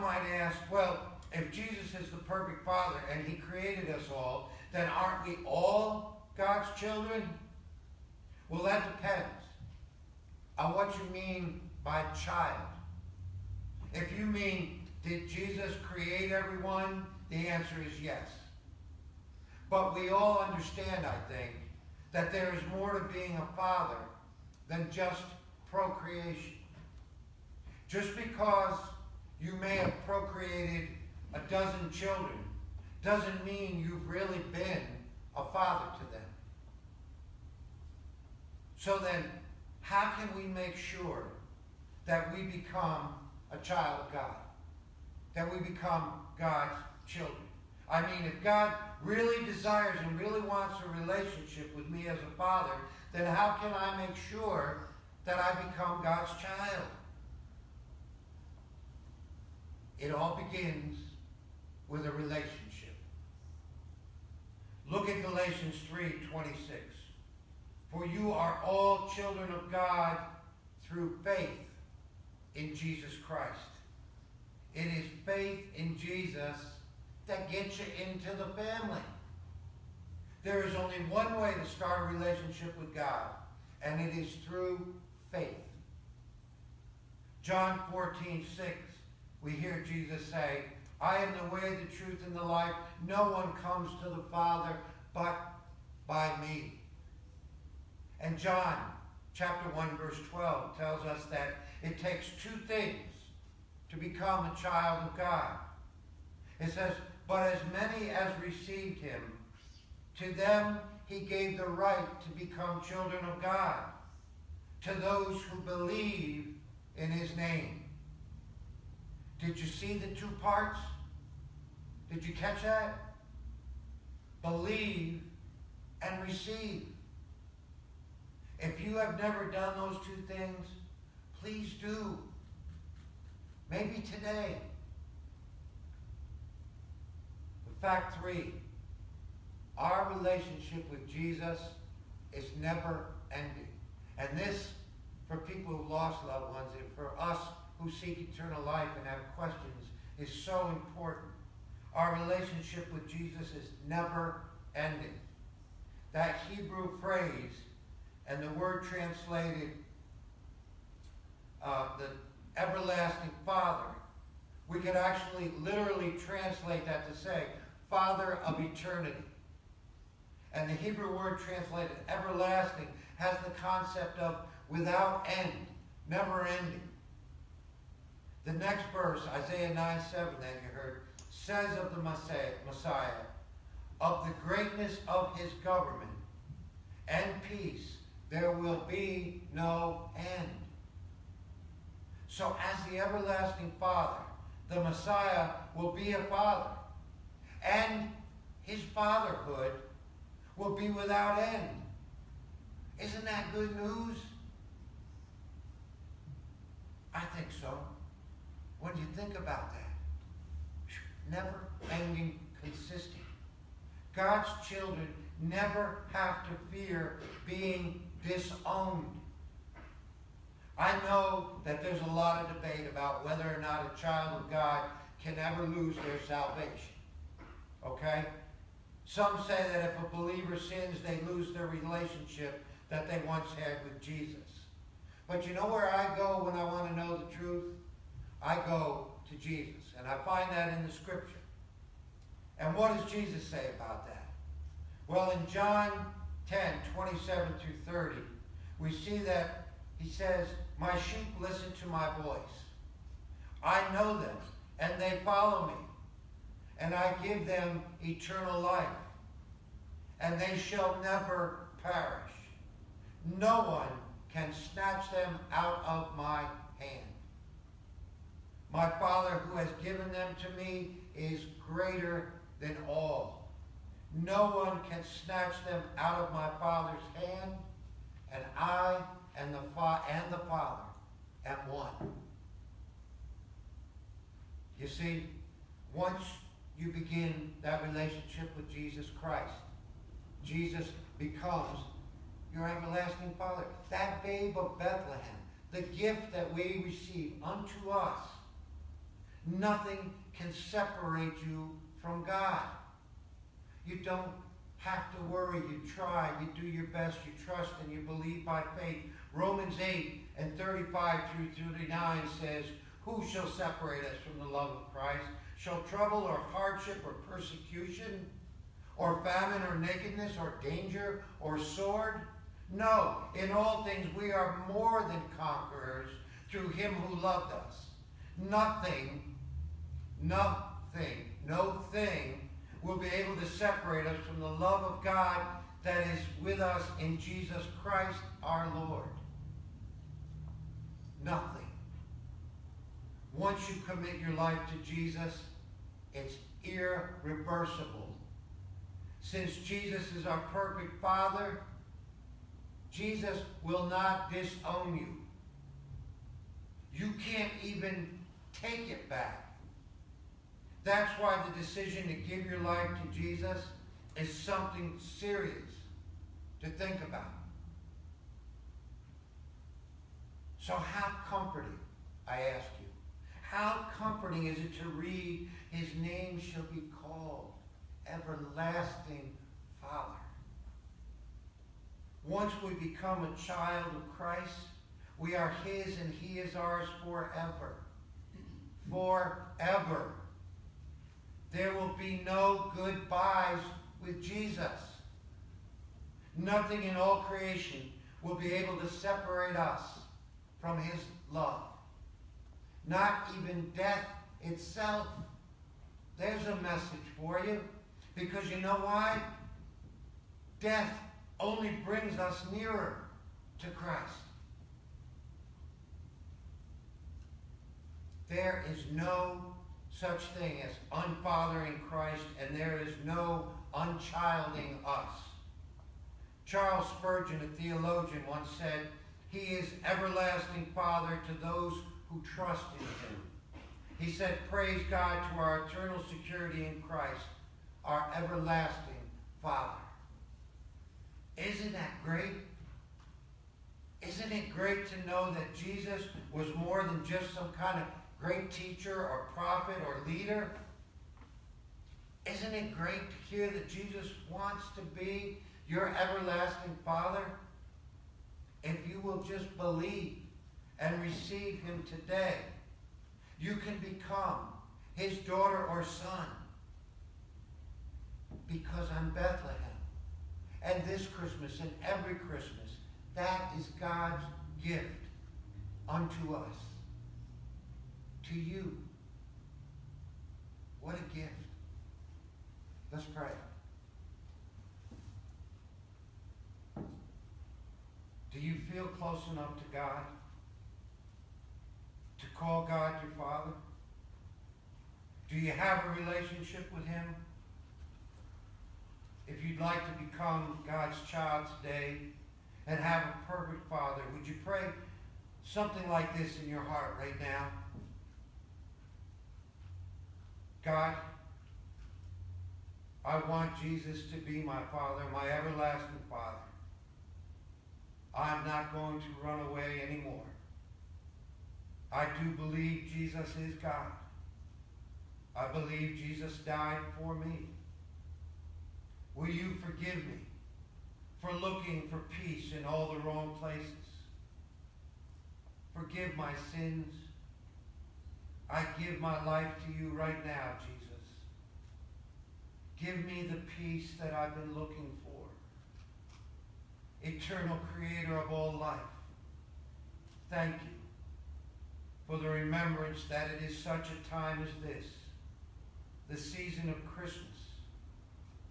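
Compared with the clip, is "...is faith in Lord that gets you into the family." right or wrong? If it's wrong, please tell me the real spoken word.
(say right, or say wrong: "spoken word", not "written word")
wrong: "Jesus", not "Lord".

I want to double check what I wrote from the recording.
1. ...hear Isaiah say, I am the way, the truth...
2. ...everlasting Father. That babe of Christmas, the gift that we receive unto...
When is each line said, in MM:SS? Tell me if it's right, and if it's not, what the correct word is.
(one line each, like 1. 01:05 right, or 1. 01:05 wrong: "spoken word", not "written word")
1. 01:29 wrong: "Jesus", not "Isaiah"
2. 04:52 wrong: "Bethlehem", not "Christmas".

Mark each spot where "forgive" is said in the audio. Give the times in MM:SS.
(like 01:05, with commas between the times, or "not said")
08:49, 08:55.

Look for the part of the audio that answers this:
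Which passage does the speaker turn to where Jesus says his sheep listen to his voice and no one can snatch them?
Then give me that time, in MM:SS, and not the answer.
04:05.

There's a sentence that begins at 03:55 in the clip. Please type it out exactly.
But you know where I go when I want to know the truth?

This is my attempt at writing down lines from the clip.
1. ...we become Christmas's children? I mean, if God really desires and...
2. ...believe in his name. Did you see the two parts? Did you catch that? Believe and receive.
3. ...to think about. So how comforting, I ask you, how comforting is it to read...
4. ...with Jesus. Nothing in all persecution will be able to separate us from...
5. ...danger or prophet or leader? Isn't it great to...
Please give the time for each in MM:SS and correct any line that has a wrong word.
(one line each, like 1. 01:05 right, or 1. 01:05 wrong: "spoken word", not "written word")
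1. 00:45 wrong: "God", not "Christmas"
2. 01:55 right
3. 06:06 right
4. 06:34 wrong: "creation", not "persecution"
5. 07:28 wrong: "teacher", not "danger".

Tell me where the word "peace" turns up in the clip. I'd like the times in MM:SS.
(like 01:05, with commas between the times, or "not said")
03:07, 08:52, 09:03.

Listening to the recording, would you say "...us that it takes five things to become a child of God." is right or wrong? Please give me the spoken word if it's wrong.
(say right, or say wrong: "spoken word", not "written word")
wrong: "two", not "five".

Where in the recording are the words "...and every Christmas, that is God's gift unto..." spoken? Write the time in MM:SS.
07:51.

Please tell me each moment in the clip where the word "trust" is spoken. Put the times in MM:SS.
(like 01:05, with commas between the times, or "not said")
05:07, 07:12.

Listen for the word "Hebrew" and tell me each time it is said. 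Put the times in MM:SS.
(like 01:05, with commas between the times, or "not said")
02:36, 02:50.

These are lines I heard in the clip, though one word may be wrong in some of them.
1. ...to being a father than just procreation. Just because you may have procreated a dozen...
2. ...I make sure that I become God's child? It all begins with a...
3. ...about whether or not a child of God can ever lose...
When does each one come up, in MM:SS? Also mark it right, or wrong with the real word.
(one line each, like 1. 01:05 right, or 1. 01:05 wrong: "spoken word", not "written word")
1. 00:22 right
2. 00:53 right
3. 03:42 right.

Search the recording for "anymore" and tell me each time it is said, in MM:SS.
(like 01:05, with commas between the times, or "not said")
08:39.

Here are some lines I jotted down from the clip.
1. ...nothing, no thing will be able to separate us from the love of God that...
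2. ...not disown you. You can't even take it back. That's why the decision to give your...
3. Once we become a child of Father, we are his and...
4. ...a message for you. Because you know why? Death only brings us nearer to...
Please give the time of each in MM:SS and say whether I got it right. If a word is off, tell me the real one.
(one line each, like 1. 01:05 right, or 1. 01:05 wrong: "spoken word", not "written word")
1. 05:30 right
2. 05:53 right
3. 06:22 wrong: "Christ", not "Father"
4. 06:46 right.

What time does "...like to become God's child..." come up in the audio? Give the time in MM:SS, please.
08:19.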